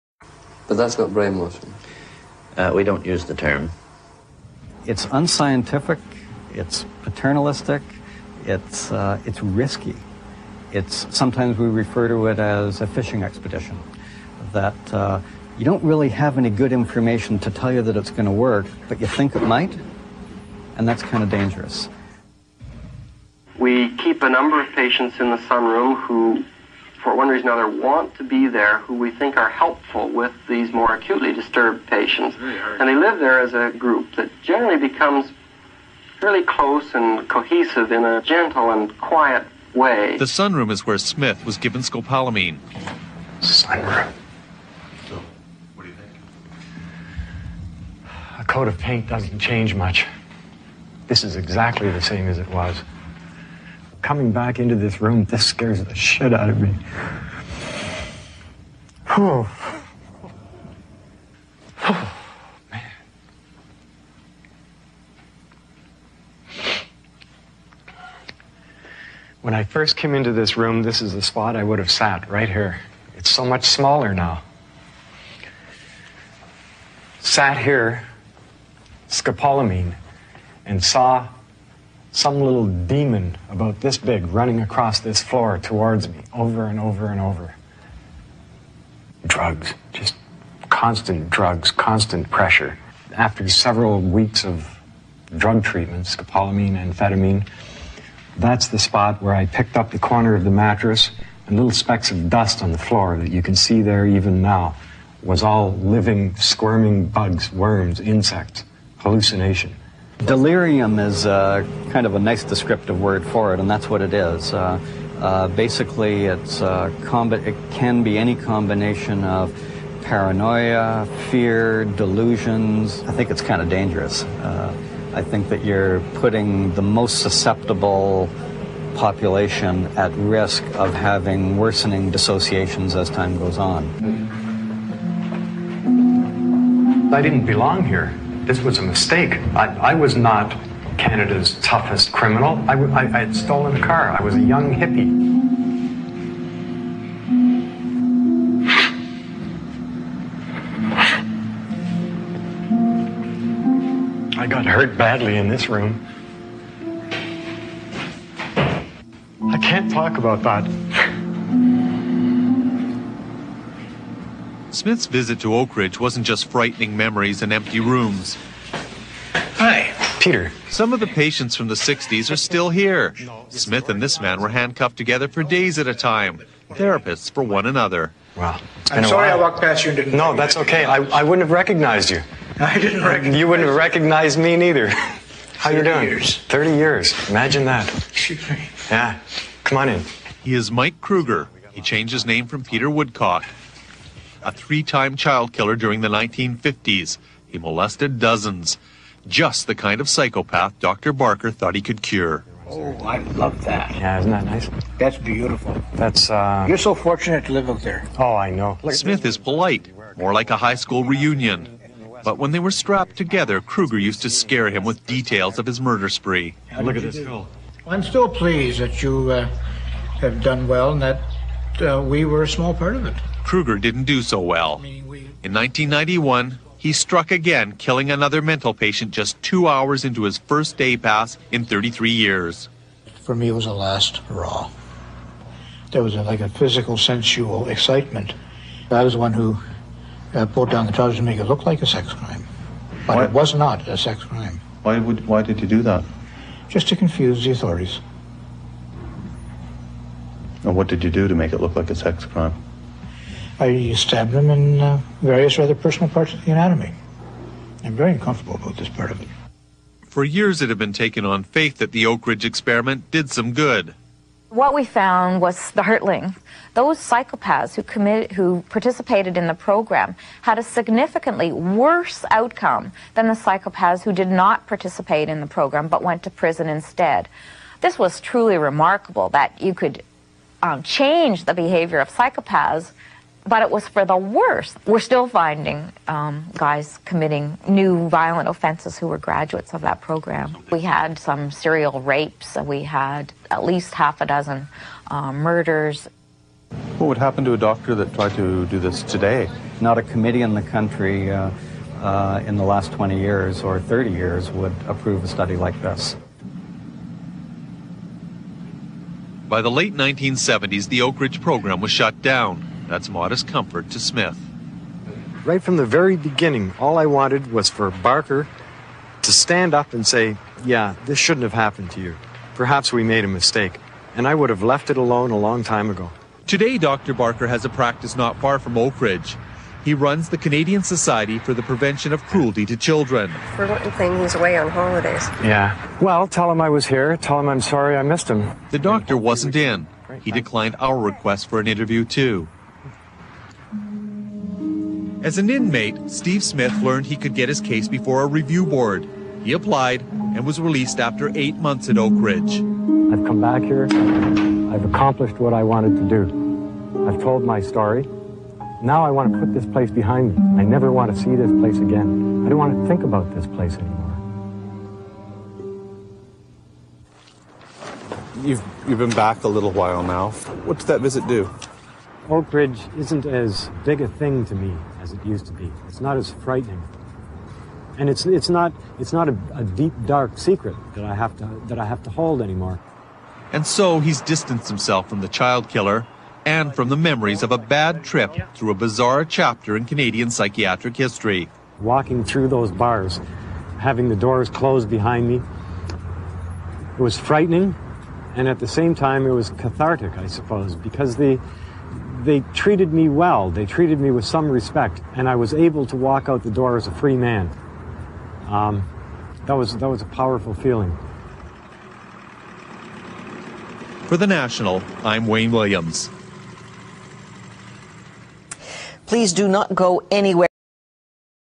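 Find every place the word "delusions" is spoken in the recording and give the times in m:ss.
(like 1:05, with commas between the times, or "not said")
2:01.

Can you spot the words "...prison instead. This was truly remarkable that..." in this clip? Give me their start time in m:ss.
4:36.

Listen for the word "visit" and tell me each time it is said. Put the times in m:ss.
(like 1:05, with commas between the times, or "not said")
2:45, 6:11.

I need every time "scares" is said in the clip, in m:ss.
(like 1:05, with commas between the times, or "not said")
0:55, 3:34.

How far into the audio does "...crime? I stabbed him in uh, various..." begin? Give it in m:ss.
4:12.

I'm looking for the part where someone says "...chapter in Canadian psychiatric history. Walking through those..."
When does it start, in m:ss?
6:29.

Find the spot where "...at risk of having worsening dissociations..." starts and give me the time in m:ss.
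2:09.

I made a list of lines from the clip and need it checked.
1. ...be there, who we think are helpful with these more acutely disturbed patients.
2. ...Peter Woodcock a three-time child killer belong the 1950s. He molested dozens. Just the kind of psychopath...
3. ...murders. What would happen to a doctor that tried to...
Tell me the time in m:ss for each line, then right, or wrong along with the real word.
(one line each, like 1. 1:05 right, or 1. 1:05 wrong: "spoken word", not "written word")
1. 0:28 right
2. 3:12 wrong: "during", not "belong"
3. 4:55 right.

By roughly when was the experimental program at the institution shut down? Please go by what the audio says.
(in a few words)
Late 1970s.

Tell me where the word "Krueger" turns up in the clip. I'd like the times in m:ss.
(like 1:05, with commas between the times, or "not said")
3:11, 3:33, 3:43.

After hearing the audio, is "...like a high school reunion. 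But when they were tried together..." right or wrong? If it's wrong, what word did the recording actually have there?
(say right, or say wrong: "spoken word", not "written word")
wrong: "strapped", not "tried".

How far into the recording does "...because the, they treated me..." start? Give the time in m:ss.
6:40.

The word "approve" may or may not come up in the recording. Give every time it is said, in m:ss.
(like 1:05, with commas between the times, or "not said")
5:04.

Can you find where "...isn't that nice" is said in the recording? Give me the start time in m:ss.
3:24.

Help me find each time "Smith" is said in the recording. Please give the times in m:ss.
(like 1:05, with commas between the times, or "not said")
0:40, 2:44, 2:53, 3:28, 5:14, 5:46.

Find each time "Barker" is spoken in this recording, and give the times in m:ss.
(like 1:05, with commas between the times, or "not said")
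3:21, 5:17, 5:27.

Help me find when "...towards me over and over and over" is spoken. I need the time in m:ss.
1:25.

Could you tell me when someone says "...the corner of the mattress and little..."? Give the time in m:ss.
1:39.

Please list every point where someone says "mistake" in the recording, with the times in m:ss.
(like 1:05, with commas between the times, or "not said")
2:18, 5:23.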